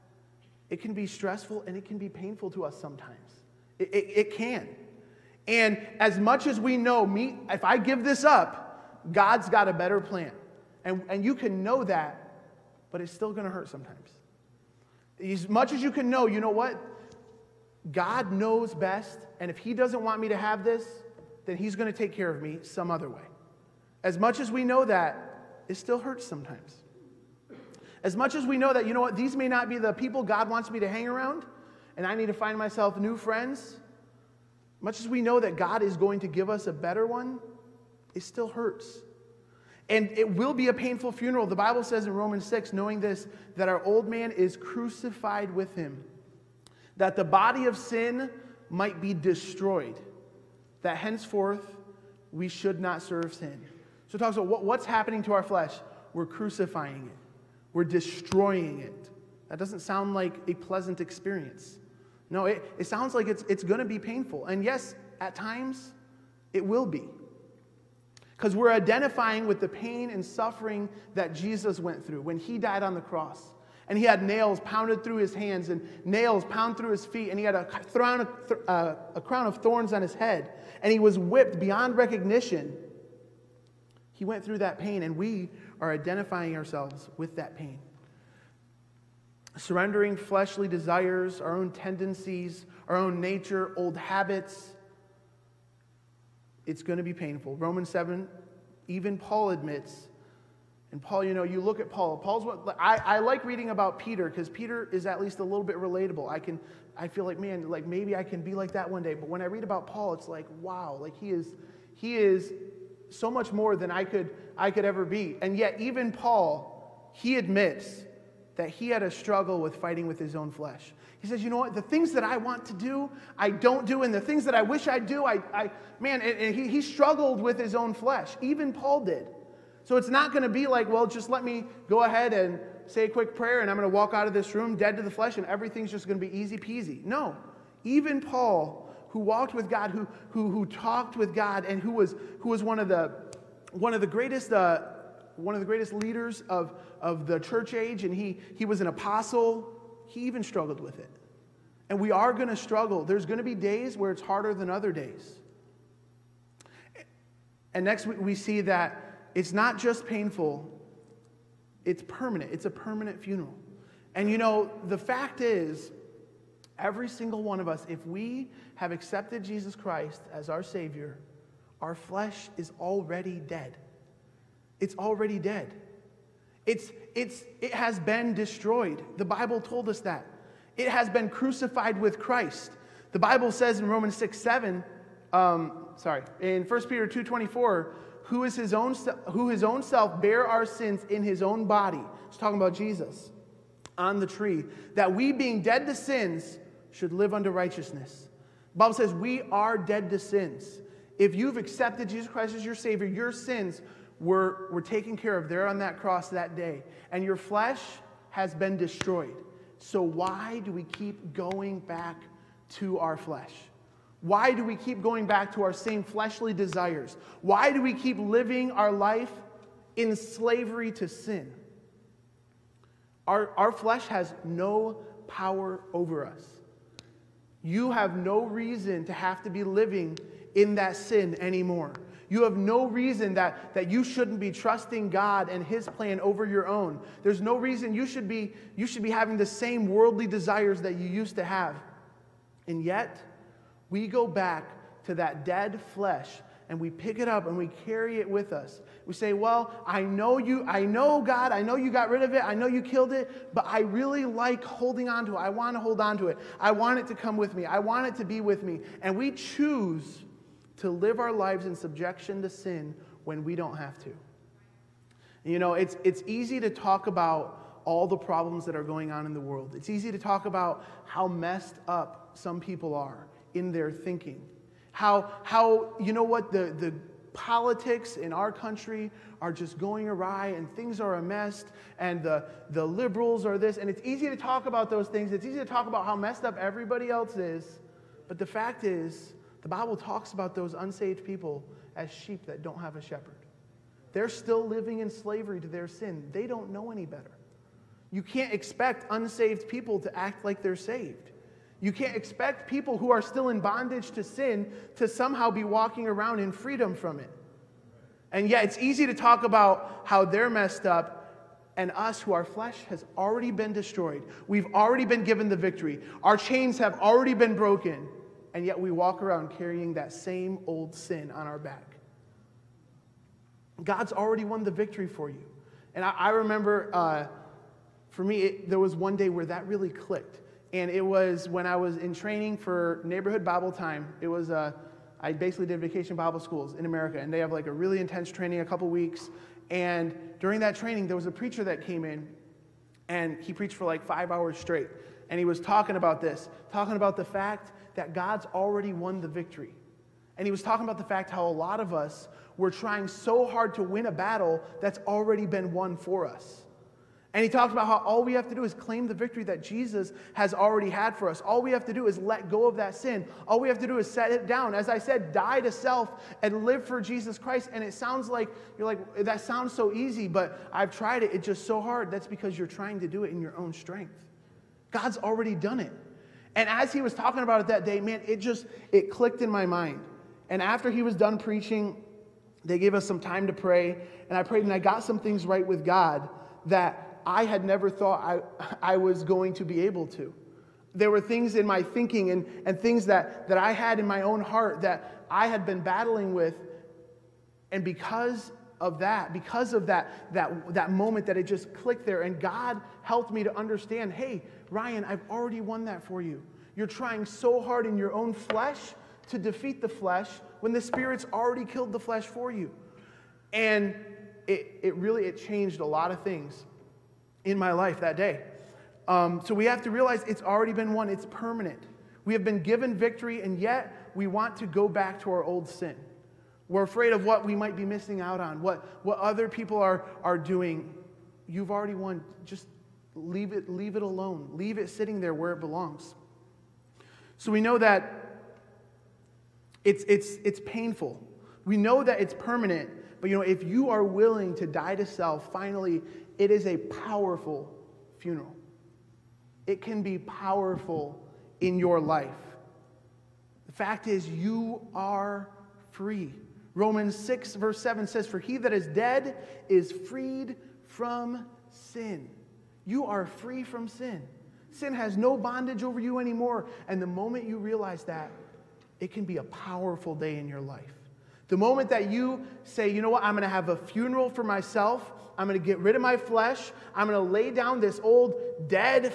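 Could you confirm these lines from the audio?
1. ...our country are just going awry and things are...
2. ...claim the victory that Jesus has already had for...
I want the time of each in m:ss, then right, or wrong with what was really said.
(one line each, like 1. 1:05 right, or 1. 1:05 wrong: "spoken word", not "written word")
1. 4:38 right
2. 5:58 right.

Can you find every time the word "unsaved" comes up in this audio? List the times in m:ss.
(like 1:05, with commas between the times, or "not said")
4:50, 4:59.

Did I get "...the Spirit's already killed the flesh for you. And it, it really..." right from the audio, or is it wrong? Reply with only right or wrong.
right.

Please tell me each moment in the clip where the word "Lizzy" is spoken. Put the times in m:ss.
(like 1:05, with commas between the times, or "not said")
not said.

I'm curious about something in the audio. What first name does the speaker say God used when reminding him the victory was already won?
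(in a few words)
Ryan.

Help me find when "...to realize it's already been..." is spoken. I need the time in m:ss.
6:59.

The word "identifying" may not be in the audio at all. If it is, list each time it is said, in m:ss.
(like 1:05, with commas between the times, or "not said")
1:08, 1:25.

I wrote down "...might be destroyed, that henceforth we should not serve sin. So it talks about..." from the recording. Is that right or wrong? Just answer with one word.
right.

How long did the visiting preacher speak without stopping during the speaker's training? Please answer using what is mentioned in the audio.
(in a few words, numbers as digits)
5 hours.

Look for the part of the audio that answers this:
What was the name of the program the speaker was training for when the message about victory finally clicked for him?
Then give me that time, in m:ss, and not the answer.
5:33.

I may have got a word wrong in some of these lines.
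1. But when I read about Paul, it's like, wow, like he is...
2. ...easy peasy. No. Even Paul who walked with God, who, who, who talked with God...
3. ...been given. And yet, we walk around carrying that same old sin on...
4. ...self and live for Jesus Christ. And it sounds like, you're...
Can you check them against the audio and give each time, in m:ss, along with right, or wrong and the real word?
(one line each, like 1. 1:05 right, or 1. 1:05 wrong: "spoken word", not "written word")
1. 1:49 right
2. 2:16 right
3. 5:17 wrong: "broken", not "given"
4. 6:05 right.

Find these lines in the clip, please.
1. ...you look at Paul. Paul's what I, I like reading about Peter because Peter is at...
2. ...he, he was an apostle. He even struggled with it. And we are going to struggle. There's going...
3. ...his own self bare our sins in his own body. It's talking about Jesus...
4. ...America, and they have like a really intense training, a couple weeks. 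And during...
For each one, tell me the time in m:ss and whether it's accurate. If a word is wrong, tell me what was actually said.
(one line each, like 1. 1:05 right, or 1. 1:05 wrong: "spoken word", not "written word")
1. 1:41 right
2. 2:28 right
3. 3:09 right
4. 5:36 right.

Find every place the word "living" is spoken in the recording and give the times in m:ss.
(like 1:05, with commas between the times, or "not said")
3:38, 3:49, 4:54.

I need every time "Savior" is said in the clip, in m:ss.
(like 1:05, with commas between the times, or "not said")
2:50, 3:22.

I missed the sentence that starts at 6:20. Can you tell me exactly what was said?
And after he was done preaching, they gave us some time to pray.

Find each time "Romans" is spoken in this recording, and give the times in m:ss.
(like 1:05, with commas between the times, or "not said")
0:42, 1:37, 3:03, 7:36.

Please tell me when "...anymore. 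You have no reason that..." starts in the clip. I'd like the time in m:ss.
3:51.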